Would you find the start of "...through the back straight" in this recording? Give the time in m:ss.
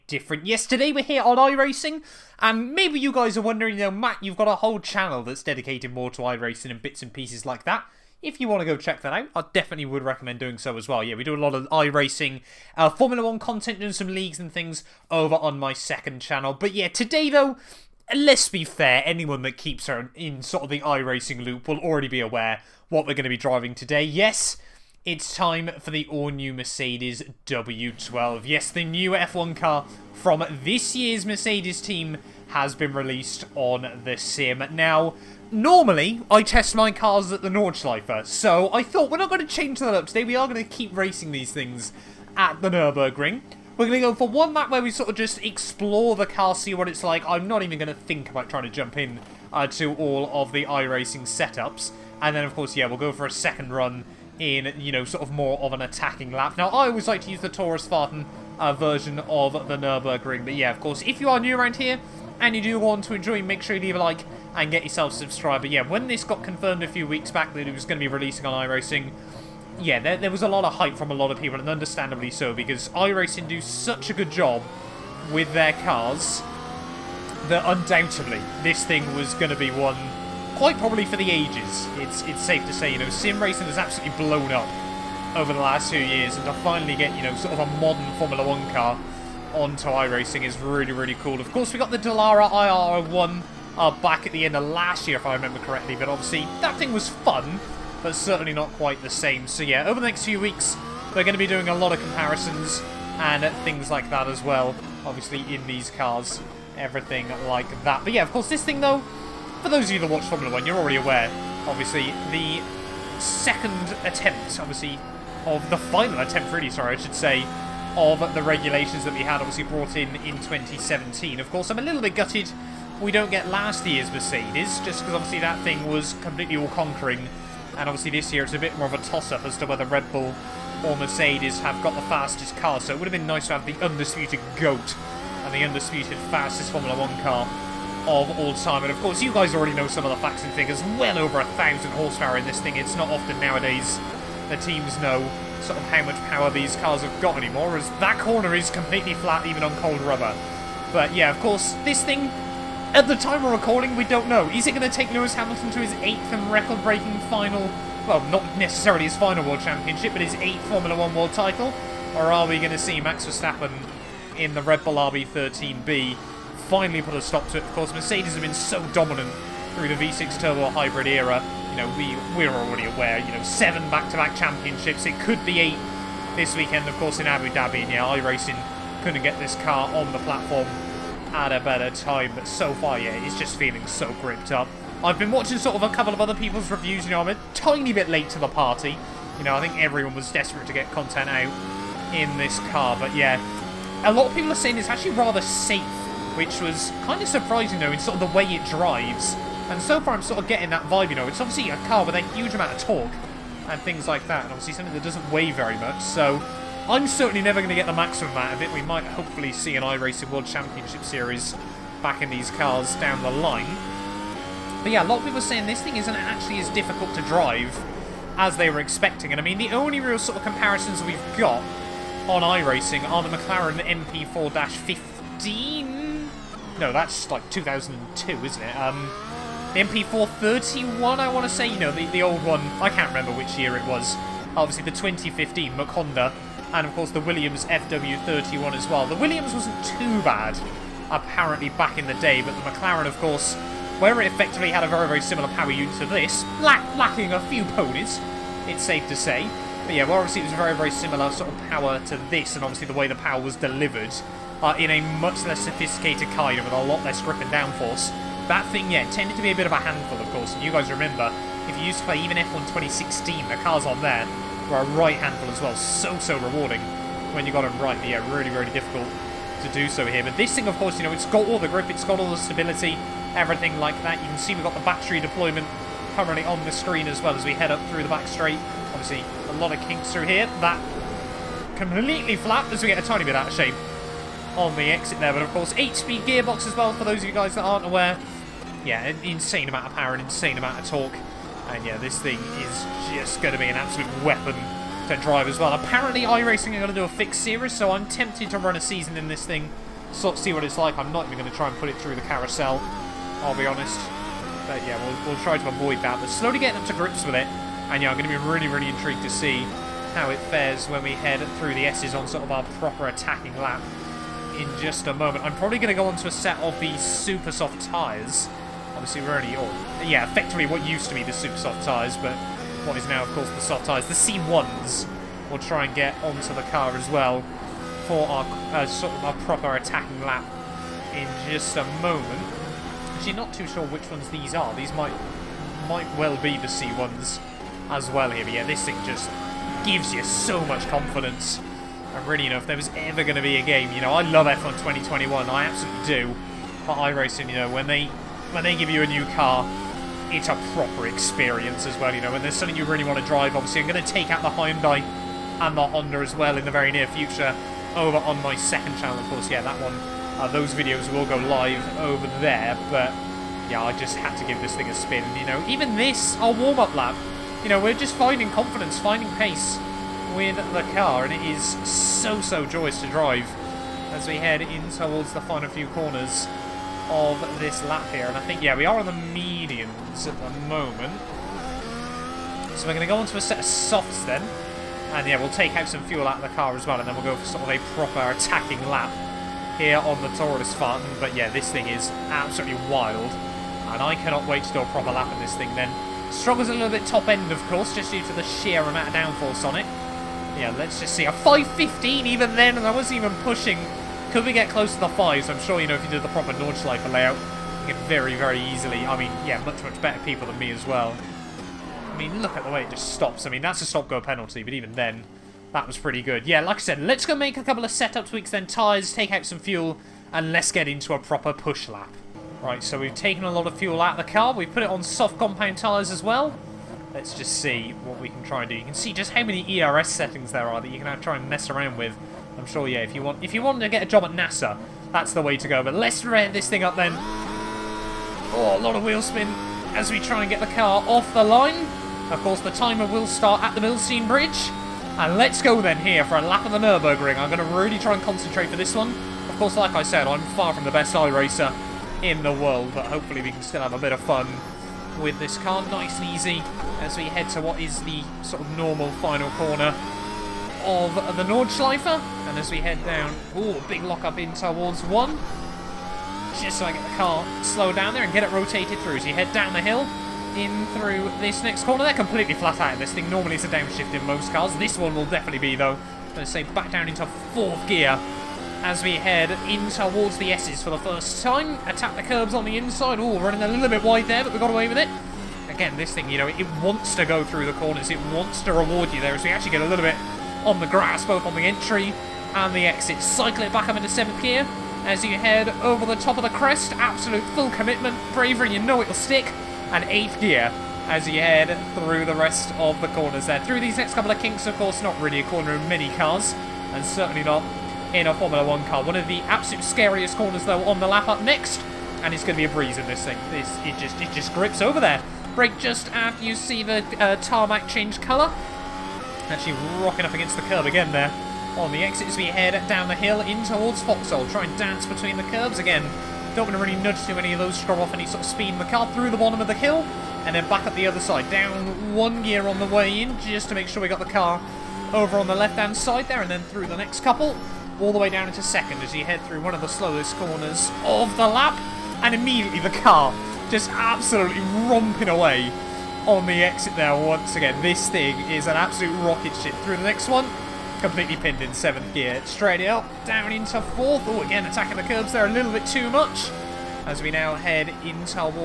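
4:37.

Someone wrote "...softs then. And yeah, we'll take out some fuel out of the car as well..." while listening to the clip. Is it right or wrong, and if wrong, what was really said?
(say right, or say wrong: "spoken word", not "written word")
right.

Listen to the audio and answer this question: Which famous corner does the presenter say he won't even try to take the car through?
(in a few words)
carousel.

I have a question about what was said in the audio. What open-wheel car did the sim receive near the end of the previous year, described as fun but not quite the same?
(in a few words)
Dallara IR01.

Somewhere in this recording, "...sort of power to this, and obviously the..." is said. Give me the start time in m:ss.
4:11.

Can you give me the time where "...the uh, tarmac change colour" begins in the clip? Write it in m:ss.
8:36.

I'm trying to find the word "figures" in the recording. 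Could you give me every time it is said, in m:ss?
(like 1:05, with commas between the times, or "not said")
2:20.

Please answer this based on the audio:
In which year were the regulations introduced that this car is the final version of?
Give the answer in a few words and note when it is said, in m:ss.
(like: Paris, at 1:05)
2017, at 2:00.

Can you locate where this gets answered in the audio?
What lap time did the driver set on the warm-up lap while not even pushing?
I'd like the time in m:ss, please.
6:41.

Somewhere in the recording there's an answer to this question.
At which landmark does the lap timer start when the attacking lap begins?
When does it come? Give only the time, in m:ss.
7:23.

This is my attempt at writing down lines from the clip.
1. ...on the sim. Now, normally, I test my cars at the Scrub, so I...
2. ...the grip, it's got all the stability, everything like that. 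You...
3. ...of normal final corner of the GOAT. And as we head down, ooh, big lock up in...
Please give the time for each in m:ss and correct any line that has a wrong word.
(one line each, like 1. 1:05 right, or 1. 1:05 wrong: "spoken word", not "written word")
1. 0:33 wrong: "Nordschleife", not "Scrub"
2. 4:31 right
3. 7:38 wrong: "Nordschleife", not "GOAT".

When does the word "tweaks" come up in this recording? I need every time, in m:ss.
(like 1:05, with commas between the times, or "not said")
6:58.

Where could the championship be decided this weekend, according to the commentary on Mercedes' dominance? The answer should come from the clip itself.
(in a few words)
Abu Dhabi.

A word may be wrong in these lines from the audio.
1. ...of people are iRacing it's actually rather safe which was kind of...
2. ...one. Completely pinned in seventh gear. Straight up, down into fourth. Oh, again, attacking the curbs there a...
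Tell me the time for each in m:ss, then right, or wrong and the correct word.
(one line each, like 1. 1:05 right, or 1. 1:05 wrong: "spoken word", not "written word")
1. 3:14 wrong: "saying", not "iRacing"
2. 9:10 right.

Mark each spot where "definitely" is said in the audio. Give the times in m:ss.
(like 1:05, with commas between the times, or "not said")
0:09, 7:55.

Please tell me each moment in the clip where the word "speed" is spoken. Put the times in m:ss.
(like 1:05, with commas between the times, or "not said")
4:45, 8:48.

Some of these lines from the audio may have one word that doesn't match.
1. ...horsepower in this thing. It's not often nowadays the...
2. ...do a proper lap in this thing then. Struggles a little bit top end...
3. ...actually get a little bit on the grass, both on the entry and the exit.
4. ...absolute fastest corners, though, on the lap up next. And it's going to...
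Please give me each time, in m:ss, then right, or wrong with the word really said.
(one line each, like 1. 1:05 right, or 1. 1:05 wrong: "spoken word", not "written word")
1. 2:21 right
2. 6:34 right
3. 8:09 right
4. 8:29 wrong: "scariest", not "fastest".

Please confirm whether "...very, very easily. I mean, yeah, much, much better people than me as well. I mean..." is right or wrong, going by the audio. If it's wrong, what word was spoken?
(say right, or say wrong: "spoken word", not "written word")
right.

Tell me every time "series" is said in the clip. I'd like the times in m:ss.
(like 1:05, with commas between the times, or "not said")
3:31, 4:57.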